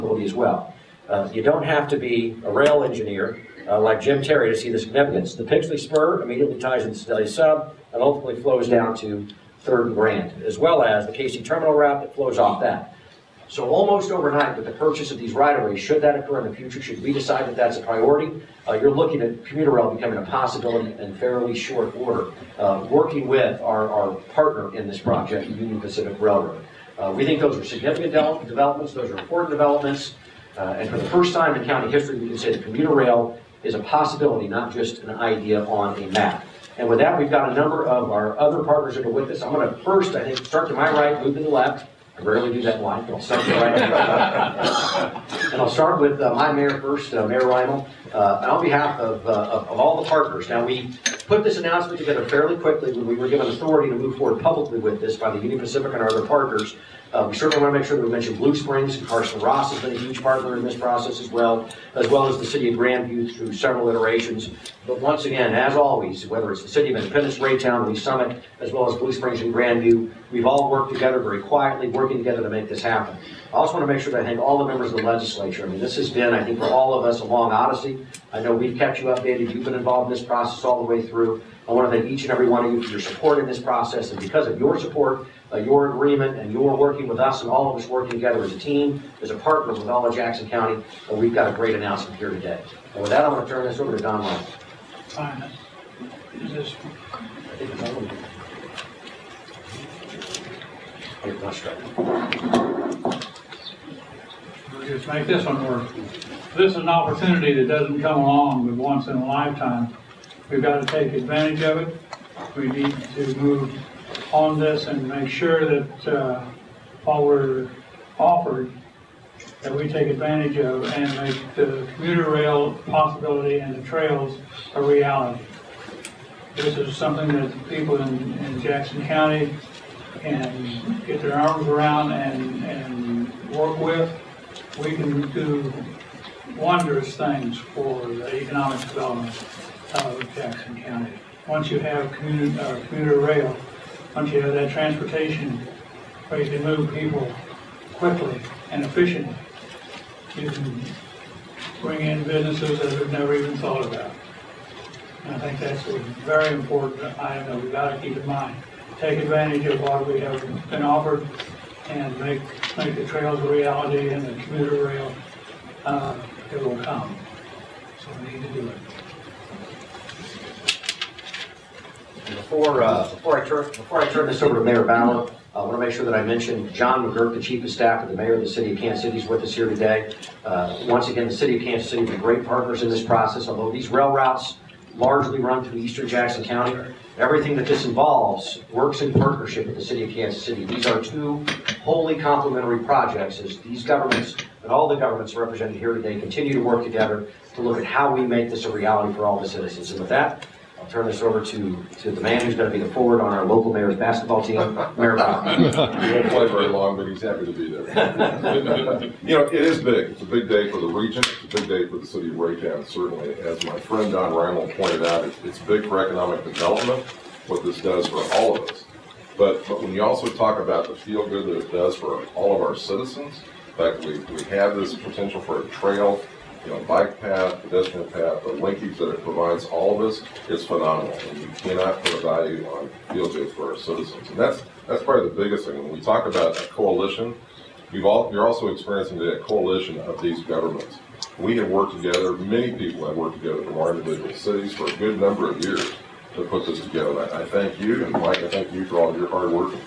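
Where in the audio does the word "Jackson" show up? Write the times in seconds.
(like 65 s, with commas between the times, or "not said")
90 s, 128 s, 140 s, 186 s.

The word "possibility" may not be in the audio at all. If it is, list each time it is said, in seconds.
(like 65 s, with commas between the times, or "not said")
20 s, 33 s, 122 s.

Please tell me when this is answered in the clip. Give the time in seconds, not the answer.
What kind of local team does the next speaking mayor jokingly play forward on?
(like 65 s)
203 s.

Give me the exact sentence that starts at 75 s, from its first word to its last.
I mean, this has been, I think, for all of us, a long odyssey.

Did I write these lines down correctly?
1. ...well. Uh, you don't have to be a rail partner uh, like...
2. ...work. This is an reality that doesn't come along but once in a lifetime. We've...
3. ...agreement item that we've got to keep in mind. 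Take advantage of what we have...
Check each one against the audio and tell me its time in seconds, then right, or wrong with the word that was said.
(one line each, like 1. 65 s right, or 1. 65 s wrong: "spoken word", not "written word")
1. 0 s wrong: "engineer", not "partner"
2. 105 s wrong: "opportunity", not "reality"
3. 156 s wrong: "important", not "agreement".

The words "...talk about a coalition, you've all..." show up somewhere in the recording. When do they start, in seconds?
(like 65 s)
235 s.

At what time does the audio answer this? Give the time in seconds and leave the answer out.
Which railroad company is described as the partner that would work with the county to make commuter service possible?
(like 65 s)
25 s.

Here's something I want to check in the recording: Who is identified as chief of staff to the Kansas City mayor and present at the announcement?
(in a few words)
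John McGurk.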